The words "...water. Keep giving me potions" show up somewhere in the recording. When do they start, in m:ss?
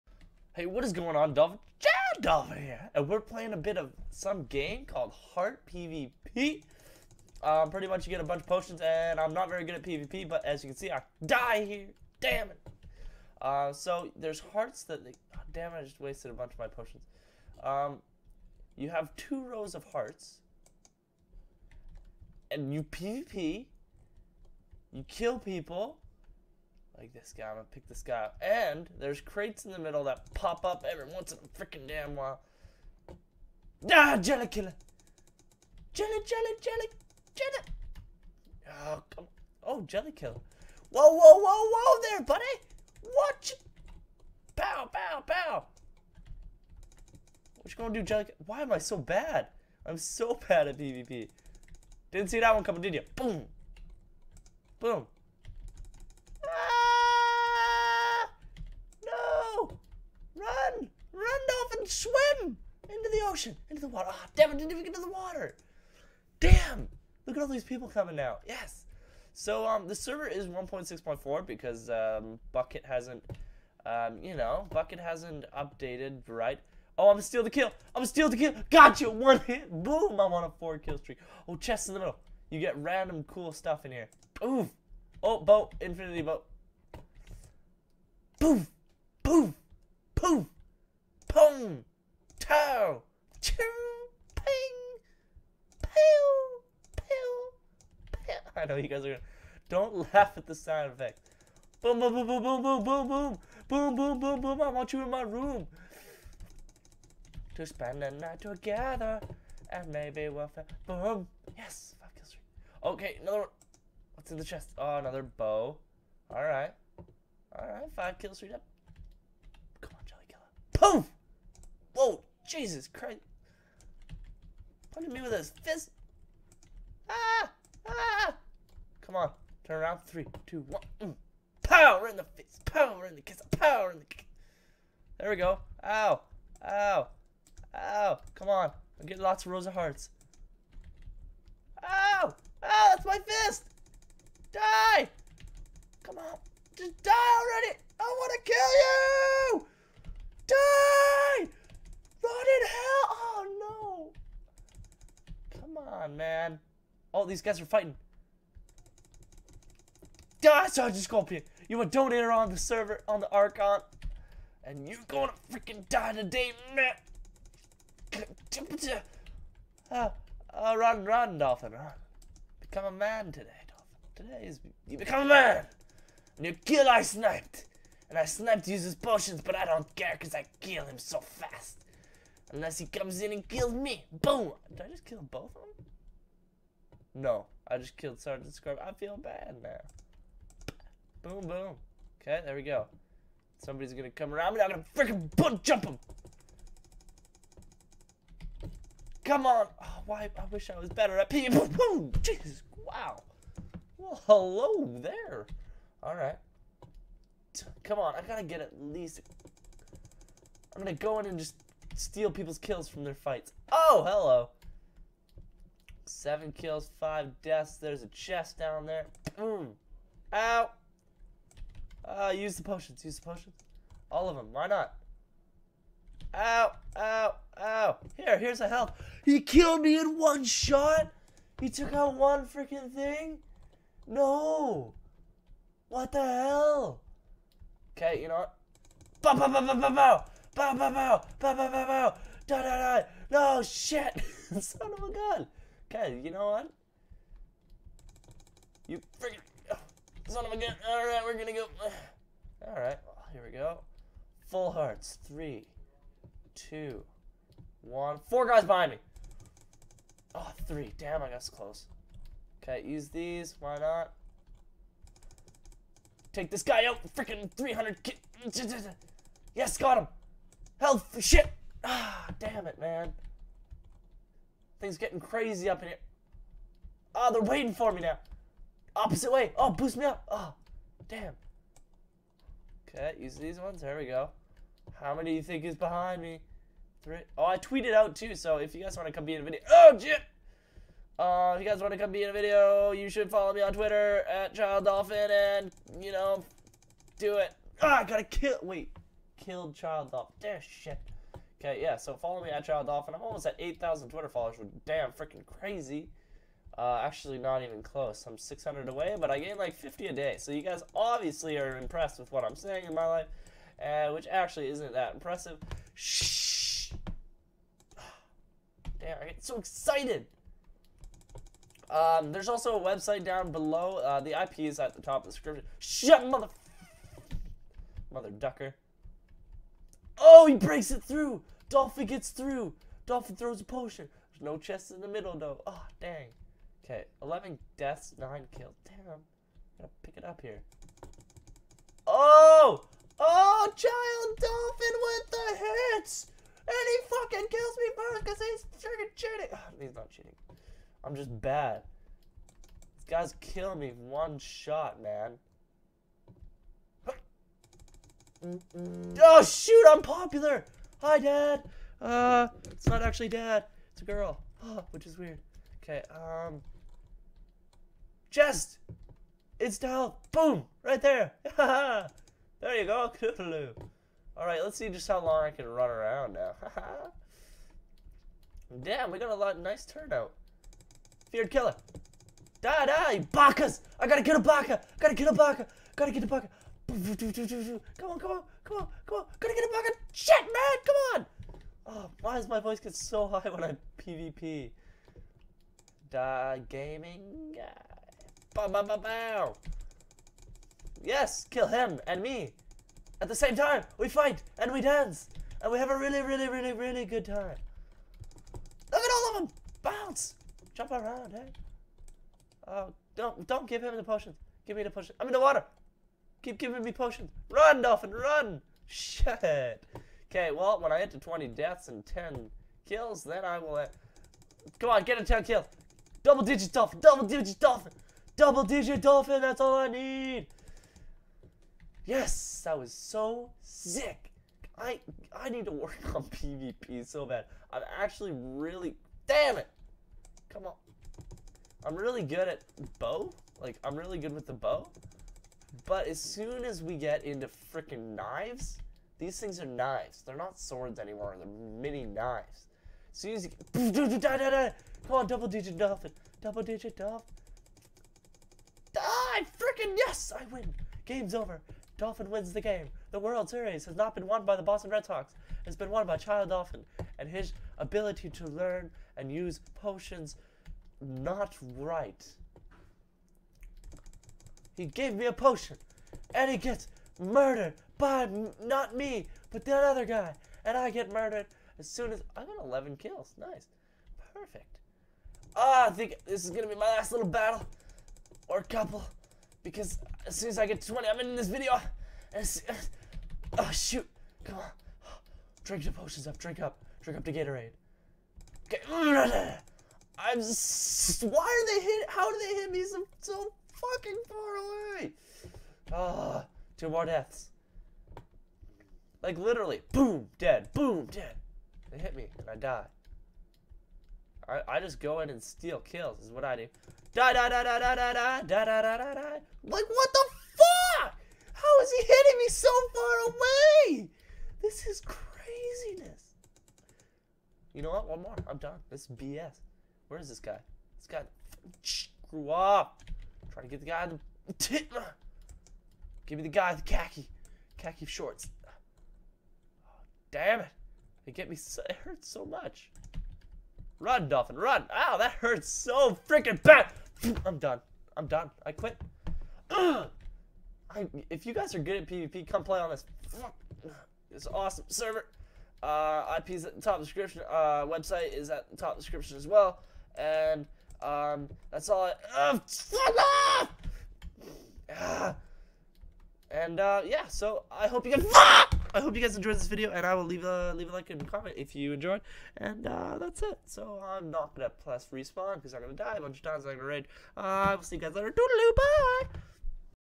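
6:55.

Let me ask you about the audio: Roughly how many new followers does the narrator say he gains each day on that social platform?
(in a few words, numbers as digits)
50.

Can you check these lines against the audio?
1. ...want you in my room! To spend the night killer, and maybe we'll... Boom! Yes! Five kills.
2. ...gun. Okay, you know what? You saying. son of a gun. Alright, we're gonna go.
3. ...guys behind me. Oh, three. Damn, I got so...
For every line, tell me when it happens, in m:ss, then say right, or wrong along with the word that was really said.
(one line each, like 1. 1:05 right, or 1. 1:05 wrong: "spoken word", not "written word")
1. 1:44 wrong: "together", not "killer"
2. 4:05 wrong: "freaking", not "saying"
3. 4:18 right.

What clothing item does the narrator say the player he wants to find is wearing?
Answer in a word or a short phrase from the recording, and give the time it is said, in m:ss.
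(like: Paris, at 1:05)
khaki shorts, at 8:56.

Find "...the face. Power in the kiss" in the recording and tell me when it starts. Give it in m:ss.
2:12.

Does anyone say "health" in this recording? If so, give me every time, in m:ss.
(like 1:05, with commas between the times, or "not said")
3:48, 4:30.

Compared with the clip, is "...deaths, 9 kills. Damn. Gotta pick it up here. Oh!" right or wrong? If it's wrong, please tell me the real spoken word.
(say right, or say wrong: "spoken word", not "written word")
right.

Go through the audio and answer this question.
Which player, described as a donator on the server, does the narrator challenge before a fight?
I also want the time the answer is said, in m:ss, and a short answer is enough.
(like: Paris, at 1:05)
Scorpion, at 2:40.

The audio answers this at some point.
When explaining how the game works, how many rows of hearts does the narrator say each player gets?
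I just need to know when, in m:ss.
0:19.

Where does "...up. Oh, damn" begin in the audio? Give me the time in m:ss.
4:40.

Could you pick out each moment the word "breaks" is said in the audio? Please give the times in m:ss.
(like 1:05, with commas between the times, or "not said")
5:30.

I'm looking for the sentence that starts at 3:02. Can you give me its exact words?
Unless he comes in and kills me.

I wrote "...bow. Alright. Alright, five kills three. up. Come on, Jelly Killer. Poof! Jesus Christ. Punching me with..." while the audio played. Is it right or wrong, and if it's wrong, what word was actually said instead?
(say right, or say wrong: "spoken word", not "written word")
right.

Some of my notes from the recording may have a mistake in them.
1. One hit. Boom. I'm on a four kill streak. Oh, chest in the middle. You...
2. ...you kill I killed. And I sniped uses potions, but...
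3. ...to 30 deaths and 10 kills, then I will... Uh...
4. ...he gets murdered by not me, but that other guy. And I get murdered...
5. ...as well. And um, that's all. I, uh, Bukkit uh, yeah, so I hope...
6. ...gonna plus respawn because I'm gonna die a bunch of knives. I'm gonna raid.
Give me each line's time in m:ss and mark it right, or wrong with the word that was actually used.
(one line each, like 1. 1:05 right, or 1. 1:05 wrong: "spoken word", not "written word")
1. 1:19 right
2. 2:56 wrong: "sniped", not "killed"
3. 7:01 wrong: "20", not "30"
4. 7:56 right
5. 9:19 wrong: "And", not "Bukkit"
6. 9:34 wrong: "times", not "knives".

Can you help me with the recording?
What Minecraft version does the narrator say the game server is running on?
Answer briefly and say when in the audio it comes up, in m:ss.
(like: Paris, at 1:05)
1.6.4, at 1:10.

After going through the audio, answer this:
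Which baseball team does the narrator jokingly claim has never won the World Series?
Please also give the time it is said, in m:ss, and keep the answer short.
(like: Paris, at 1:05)
Boston Red Sox, at 7:44.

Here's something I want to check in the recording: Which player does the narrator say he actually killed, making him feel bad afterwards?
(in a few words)
Sergeant Scrub.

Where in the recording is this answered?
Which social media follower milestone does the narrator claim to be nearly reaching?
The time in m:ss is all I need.
5:03.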